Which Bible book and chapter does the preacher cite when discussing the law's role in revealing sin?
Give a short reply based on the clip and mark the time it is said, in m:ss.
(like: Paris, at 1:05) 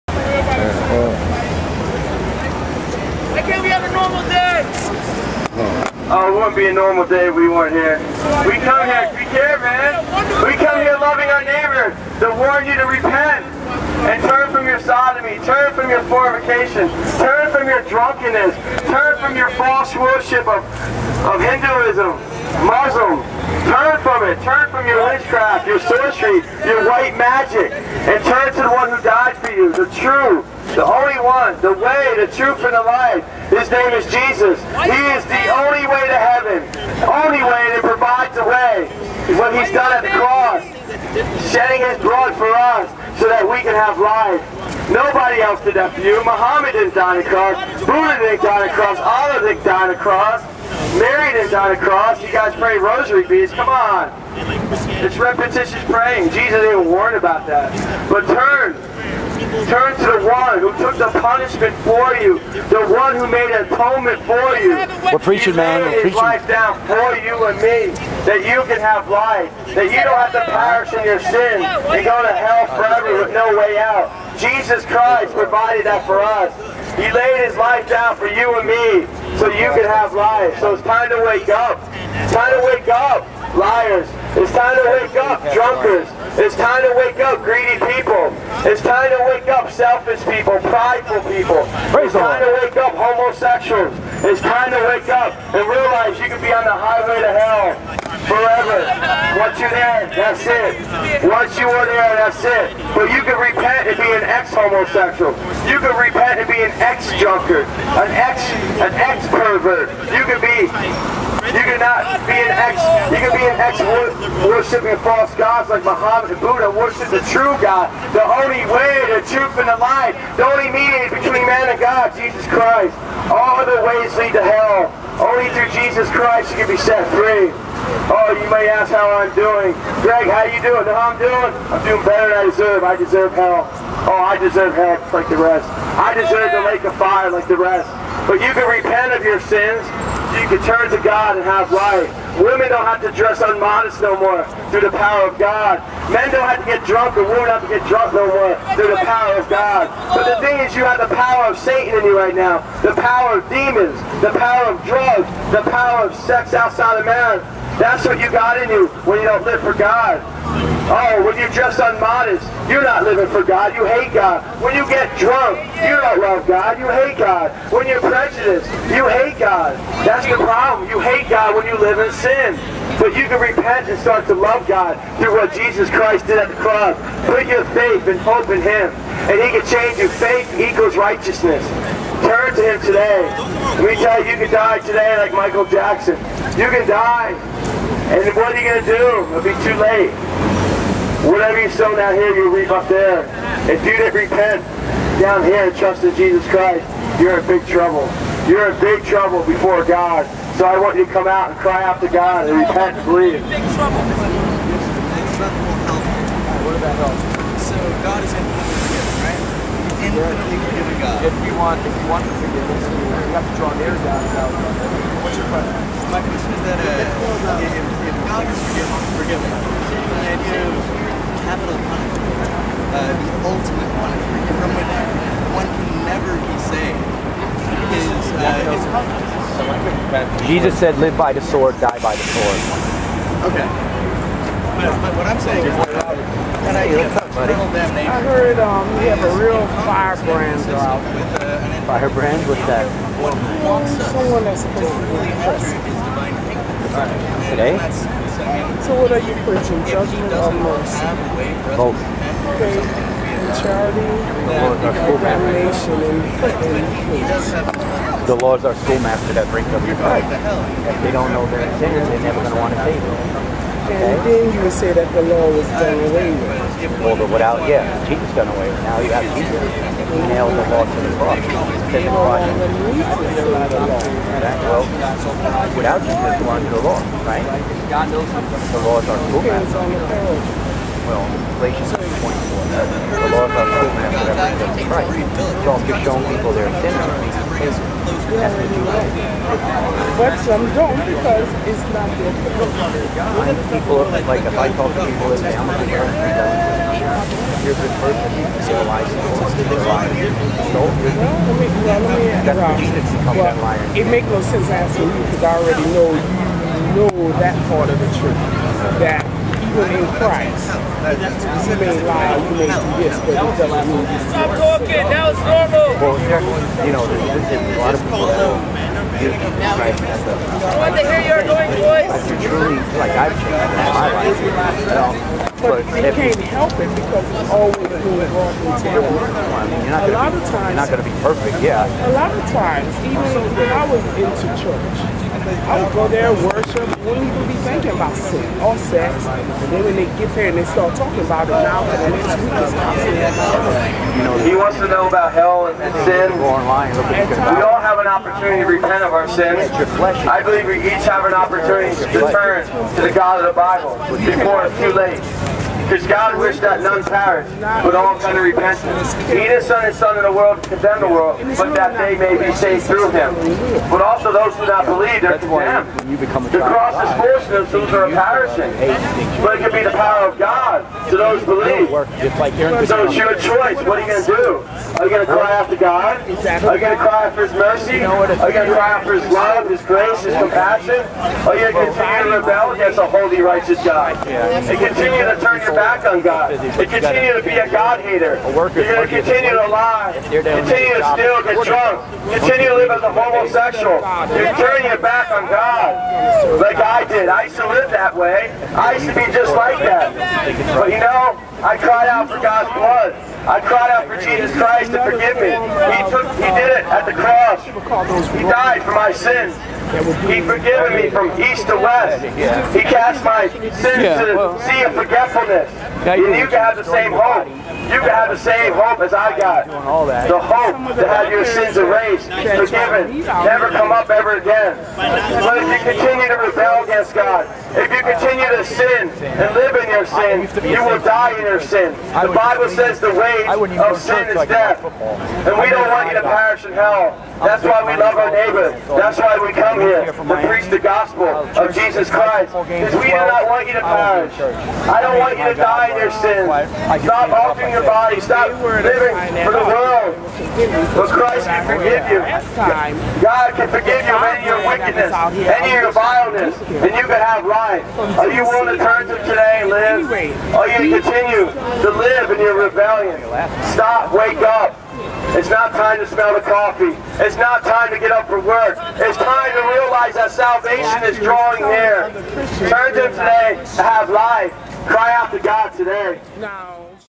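Galatians 24, at 4:41.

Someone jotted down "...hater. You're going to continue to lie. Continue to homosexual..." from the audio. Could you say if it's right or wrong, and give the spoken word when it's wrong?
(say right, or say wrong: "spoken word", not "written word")
wrong: "steal", not "homosexual".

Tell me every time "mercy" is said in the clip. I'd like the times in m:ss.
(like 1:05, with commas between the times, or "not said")
4:10, 6:17.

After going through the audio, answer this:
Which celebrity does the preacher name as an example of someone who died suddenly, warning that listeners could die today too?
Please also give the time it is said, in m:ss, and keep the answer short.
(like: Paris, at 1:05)
Michael Jackson, at 3:05.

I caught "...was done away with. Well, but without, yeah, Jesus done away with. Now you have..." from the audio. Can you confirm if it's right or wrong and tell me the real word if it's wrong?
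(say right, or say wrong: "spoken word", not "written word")
right.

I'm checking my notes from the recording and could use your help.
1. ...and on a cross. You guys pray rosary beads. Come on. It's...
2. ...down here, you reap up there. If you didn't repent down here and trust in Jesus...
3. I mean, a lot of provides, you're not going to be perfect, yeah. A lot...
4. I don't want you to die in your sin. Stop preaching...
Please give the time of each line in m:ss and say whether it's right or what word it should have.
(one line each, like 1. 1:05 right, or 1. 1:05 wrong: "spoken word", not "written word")
1. 0:51 right
2. 3:11 right
3. 5:29 wrong: "times", not "provides"
4. 7:24 wrong: "opening", not "preaching".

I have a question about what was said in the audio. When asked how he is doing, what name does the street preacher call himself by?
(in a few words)
Greg.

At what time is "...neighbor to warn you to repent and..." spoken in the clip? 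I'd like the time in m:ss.
0:11.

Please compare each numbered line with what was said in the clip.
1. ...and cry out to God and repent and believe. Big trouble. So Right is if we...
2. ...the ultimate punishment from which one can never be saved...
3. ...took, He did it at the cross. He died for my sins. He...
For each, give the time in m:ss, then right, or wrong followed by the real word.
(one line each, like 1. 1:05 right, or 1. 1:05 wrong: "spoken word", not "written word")
1. 3:21 wrong: "God", not "Right"
2. 3:43 right
3. 6:46 right.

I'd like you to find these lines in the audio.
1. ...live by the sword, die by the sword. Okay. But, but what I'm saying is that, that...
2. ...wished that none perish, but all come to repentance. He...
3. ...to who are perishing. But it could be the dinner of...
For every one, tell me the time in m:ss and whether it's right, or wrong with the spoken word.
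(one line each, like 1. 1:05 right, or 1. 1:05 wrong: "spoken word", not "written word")
1. 3:50 right
2. 5:56 right
3. 6:07 wrong: "power", not "dinner".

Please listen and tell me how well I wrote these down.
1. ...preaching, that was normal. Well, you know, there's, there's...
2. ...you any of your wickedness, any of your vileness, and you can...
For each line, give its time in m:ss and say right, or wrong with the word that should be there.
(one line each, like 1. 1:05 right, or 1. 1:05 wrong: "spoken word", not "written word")
1. 5:14 wrong: "talking", not "preaching"
2. 7:34 right.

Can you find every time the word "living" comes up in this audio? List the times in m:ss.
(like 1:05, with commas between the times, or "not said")
2:43, 7:28.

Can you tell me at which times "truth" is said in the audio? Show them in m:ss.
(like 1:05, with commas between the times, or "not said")
0:32, 1:59, 5:08.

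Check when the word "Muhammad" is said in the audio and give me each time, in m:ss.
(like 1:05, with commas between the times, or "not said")
0:46, 1:55.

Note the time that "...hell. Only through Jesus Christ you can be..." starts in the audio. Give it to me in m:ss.
2:04.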